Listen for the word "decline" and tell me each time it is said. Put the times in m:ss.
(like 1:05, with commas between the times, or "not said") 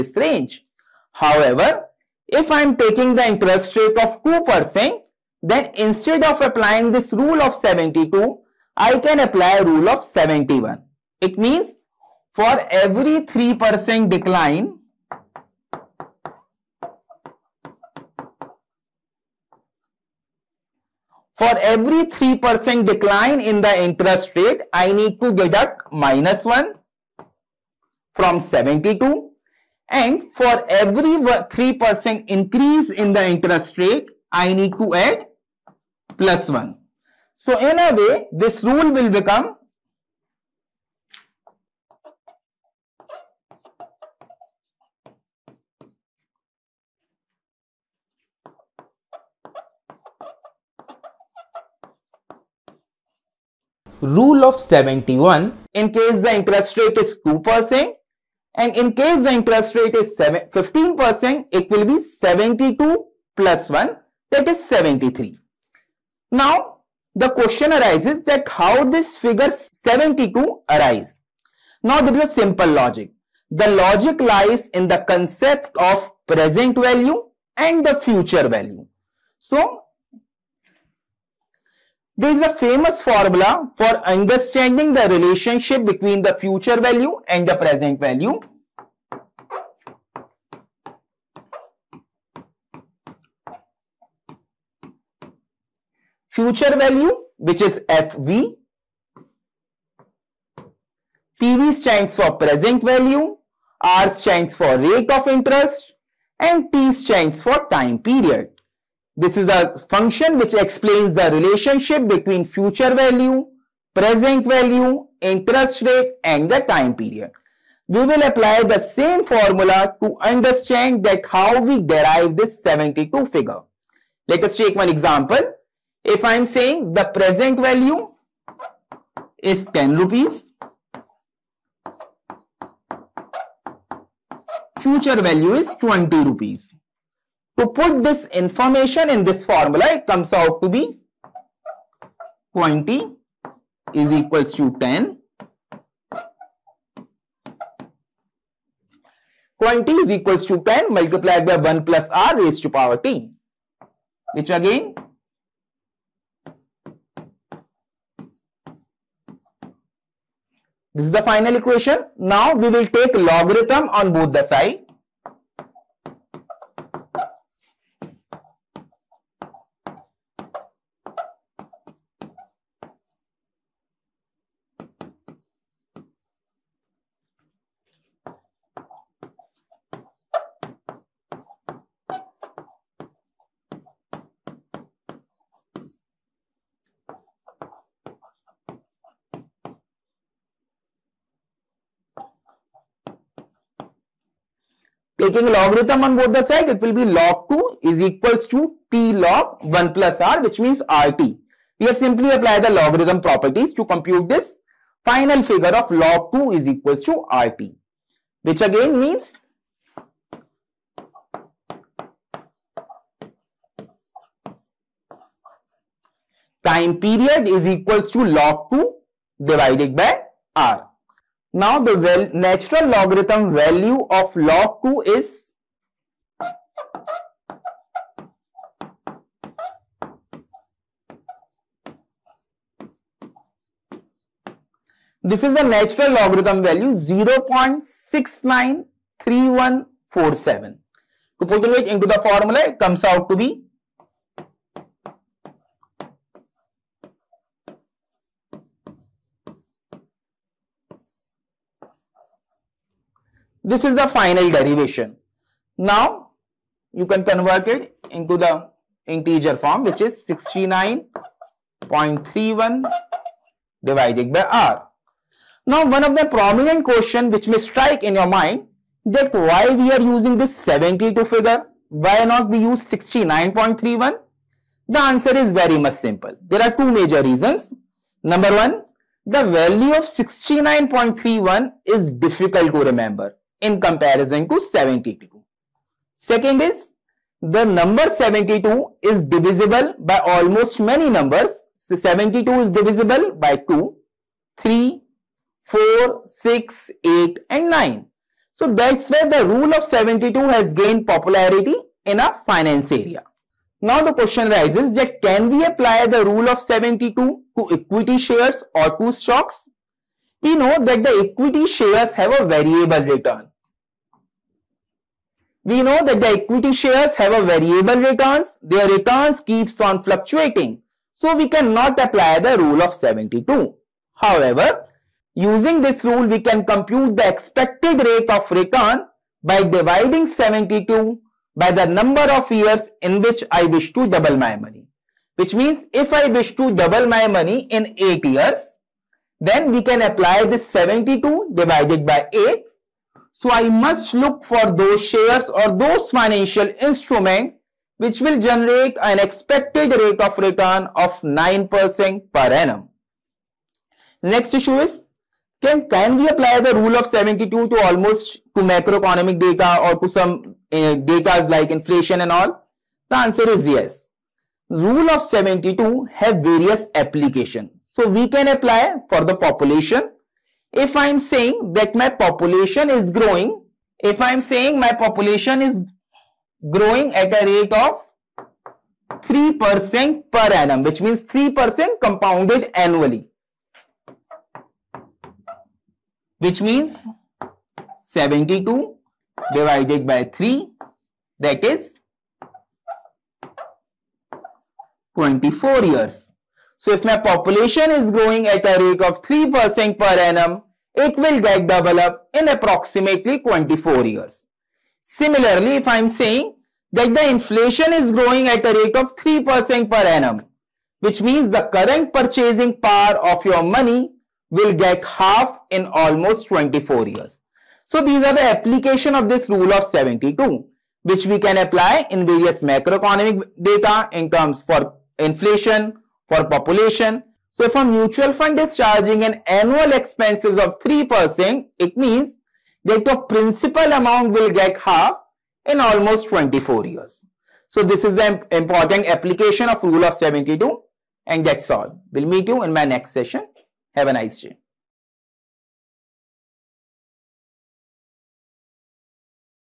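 0:14, 0:22.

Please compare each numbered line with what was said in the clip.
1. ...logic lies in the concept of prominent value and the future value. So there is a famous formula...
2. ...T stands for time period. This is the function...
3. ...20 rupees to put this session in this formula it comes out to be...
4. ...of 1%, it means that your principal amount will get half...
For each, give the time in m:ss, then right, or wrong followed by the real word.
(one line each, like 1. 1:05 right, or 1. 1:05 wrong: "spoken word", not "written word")
1. 1:13 wrong: "present", not "prominent"
2. 1:46 right
3. 2:15 wrong: "information", not "session"
4. 7:10 wrong: "3", not "1".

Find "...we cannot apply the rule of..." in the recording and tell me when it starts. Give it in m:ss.
5:21.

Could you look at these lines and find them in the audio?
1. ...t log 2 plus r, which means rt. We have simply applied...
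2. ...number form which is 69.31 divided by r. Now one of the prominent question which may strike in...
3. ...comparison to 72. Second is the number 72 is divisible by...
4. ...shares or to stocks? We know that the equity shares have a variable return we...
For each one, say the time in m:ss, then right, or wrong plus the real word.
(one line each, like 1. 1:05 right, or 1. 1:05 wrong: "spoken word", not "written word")
1. 3:18 wrong: "1", not "2"
2. 4:19 wrong: "integer", not "number"
3. 4:43 right
4. 5:08 right.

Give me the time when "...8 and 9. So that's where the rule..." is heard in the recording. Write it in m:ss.
4:57.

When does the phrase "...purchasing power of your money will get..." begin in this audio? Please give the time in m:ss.
6:52.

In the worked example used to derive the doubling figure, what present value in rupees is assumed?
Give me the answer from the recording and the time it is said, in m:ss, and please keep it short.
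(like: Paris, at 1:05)
10 rupees, at 2:09.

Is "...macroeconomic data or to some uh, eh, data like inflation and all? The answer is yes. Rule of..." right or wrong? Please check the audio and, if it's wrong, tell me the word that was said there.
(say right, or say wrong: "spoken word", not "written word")
right.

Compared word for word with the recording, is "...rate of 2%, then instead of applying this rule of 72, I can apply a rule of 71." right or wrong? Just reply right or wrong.
right.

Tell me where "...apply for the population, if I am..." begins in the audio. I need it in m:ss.
6:08.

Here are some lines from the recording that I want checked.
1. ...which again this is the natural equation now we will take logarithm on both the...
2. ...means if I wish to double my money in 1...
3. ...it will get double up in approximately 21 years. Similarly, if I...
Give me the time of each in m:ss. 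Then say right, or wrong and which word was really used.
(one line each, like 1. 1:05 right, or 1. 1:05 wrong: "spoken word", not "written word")
1. 2:34 wrong: "final", not "natural"
2. 5:35 wrong: "8", not "1"
3. 6:40 wrong: "24", not "21".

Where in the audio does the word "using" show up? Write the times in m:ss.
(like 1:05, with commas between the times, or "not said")
4:30, 5:25.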